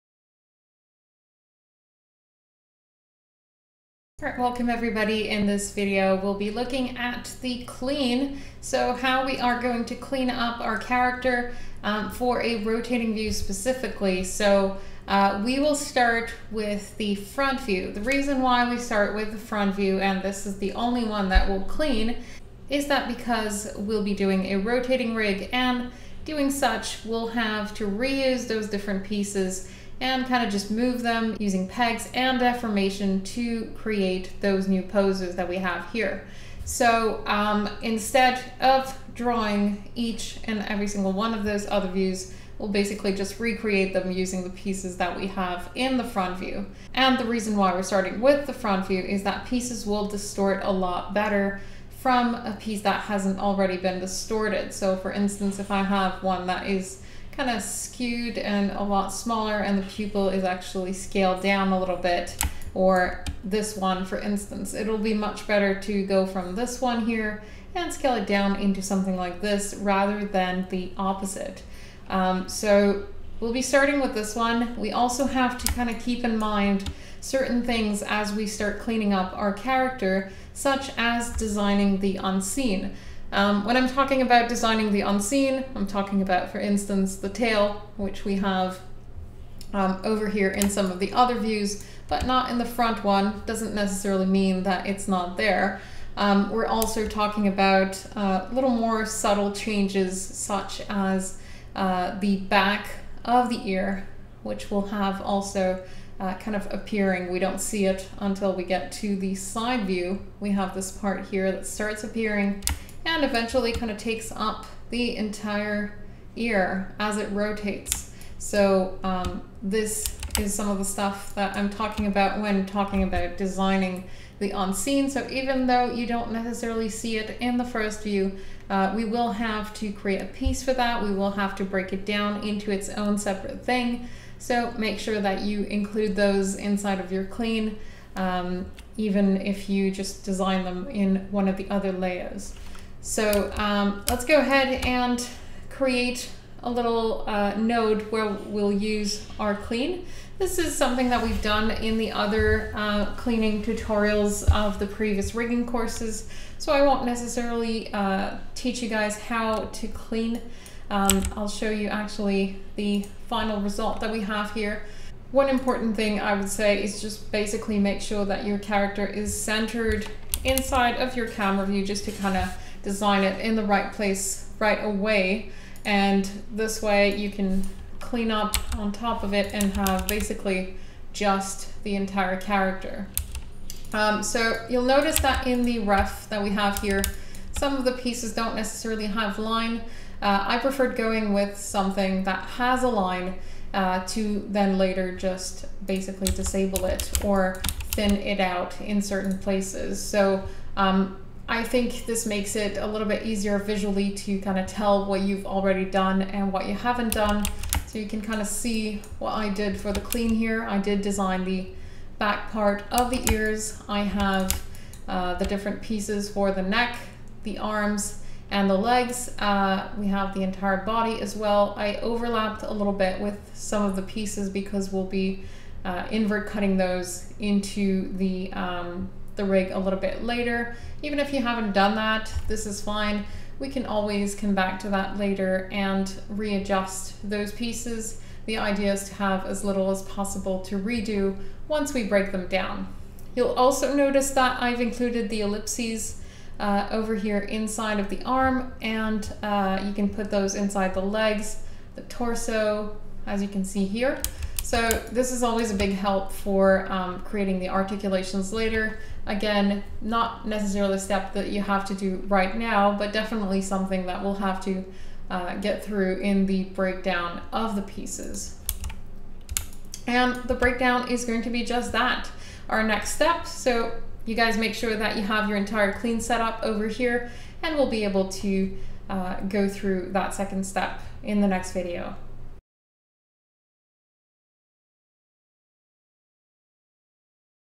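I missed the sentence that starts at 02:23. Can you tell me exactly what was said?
So um, let's go ahead and create a little uh, node where we'll use our clean.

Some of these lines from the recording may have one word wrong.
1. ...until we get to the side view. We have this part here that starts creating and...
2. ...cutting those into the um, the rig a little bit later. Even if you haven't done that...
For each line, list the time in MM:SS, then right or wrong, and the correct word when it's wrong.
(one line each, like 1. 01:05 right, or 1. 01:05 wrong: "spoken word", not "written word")
1. 01:48 wrong: "appearing", not "creating"
2. 03:46 right.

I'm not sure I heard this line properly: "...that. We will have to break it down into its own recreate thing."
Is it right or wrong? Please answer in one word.
wrong.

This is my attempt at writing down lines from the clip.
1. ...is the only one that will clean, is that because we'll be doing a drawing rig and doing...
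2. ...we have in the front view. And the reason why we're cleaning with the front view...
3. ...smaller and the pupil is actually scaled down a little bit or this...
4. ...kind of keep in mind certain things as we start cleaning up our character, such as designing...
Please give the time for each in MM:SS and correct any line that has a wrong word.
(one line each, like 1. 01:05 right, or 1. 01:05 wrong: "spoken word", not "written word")
1. 00:20 wrong: "rotating", not "drawing"
2. 00:45 wrong: "starting", not "cleaning"
3. 00:59 right
4. 01:15 right.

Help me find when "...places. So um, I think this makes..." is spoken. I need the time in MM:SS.
03:19.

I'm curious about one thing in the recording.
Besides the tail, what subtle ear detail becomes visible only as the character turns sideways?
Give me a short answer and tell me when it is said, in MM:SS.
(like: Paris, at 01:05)
The back of the ear, at 01:42.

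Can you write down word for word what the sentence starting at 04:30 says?
And the breakdown is going to be just that, our next step.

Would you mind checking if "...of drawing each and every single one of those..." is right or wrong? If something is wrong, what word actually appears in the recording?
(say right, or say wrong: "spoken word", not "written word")
right.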